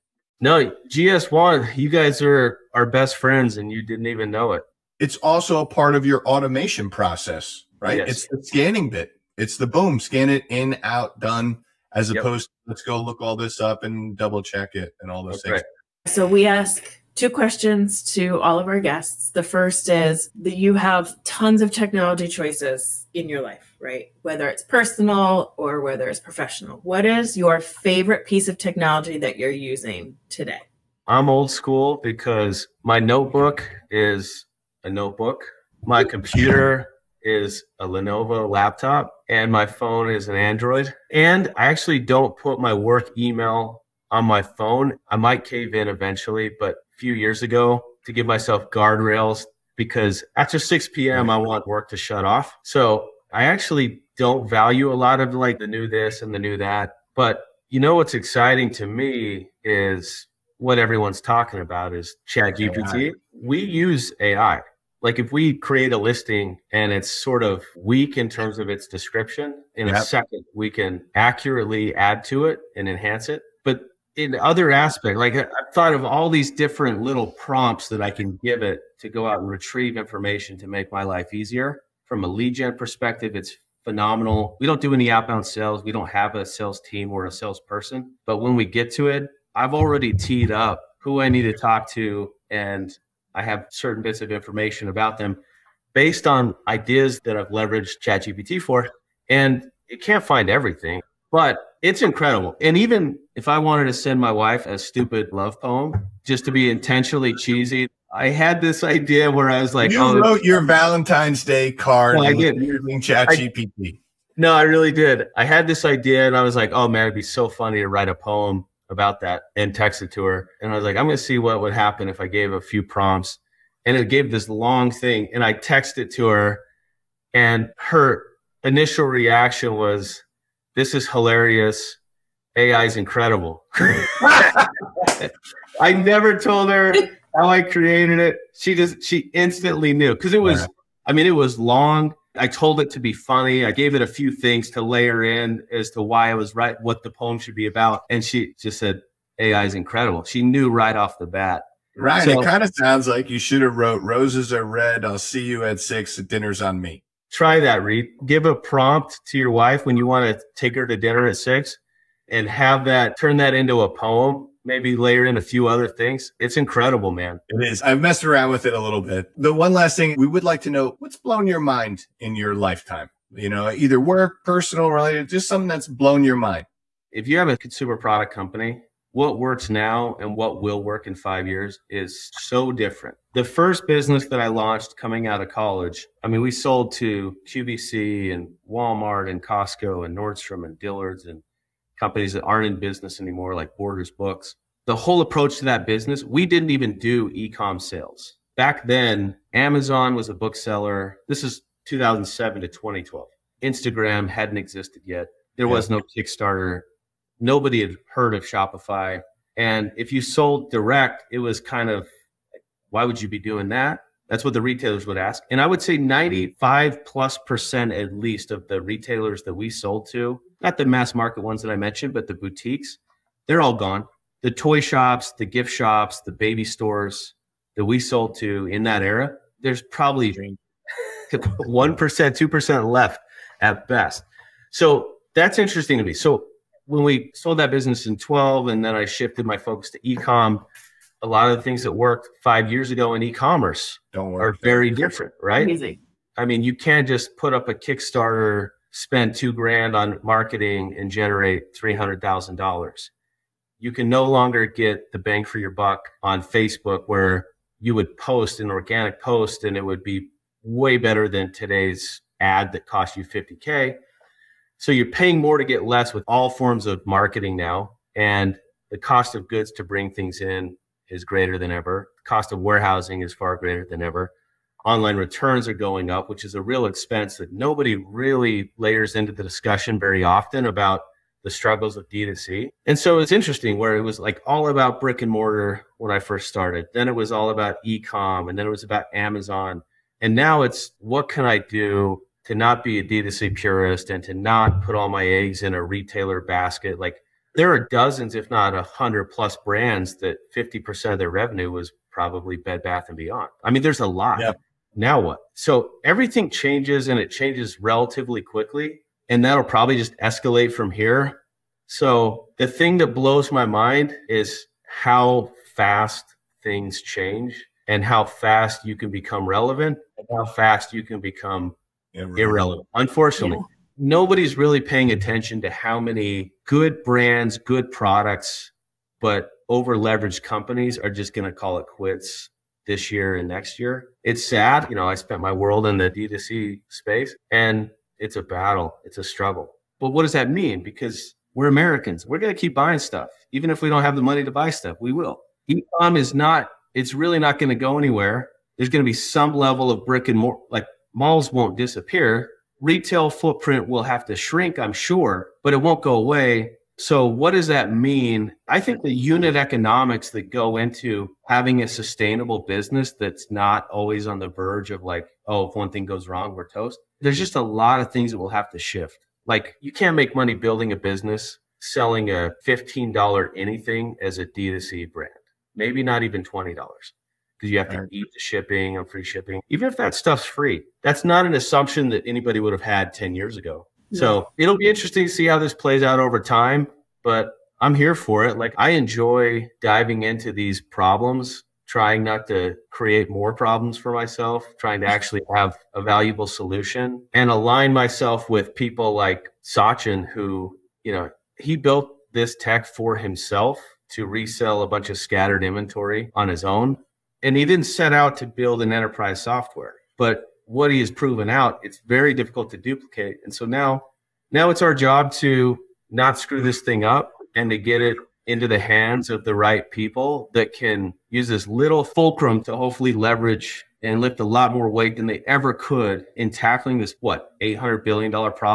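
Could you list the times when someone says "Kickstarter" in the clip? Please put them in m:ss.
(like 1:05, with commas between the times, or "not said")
3:26, 4:07.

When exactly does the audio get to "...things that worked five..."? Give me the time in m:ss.
4:01.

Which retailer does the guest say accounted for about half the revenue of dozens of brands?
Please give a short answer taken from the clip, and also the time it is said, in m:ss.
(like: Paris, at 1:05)
Bed Bath and Beyond, at 5:02.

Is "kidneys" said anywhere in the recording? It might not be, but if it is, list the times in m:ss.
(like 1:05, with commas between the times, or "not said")
not said.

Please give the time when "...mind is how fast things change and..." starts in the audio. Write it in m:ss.
5:13.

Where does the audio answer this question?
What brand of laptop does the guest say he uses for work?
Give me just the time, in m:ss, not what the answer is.
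0:37.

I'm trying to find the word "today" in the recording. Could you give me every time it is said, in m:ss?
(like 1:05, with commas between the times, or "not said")
0:30, 4:21.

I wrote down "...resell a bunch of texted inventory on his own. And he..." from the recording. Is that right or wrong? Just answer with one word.
wrong.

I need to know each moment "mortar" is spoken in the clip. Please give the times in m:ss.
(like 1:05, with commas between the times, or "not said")
4:45, 5:50.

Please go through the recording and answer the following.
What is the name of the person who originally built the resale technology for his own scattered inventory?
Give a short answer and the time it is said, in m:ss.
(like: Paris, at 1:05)
Sachin, at 6:39.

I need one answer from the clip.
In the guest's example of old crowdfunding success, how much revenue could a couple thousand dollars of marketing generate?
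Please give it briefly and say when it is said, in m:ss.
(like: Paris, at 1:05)
$300,000, at 4:11.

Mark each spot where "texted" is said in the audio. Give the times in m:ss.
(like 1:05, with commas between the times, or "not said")
1:59, 2:05.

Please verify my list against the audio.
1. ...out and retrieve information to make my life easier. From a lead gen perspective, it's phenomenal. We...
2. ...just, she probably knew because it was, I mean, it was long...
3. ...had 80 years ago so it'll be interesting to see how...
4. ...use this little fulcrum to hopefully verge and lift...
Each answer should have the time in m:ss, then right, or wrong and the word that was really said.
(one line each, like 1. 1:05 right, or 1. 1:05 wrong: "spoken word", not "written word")
1. 1:19 right
2. 2:18 wrong: "instantly", not "probably"
3. 6:22 wrong: "10", not "80"
4. 7:01 wrong: "leverage", not "verge".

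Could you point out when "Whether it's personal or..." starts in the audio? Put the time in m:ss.
0:24.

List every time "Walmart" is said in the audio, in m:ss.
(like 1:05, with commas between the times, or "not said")
3:08.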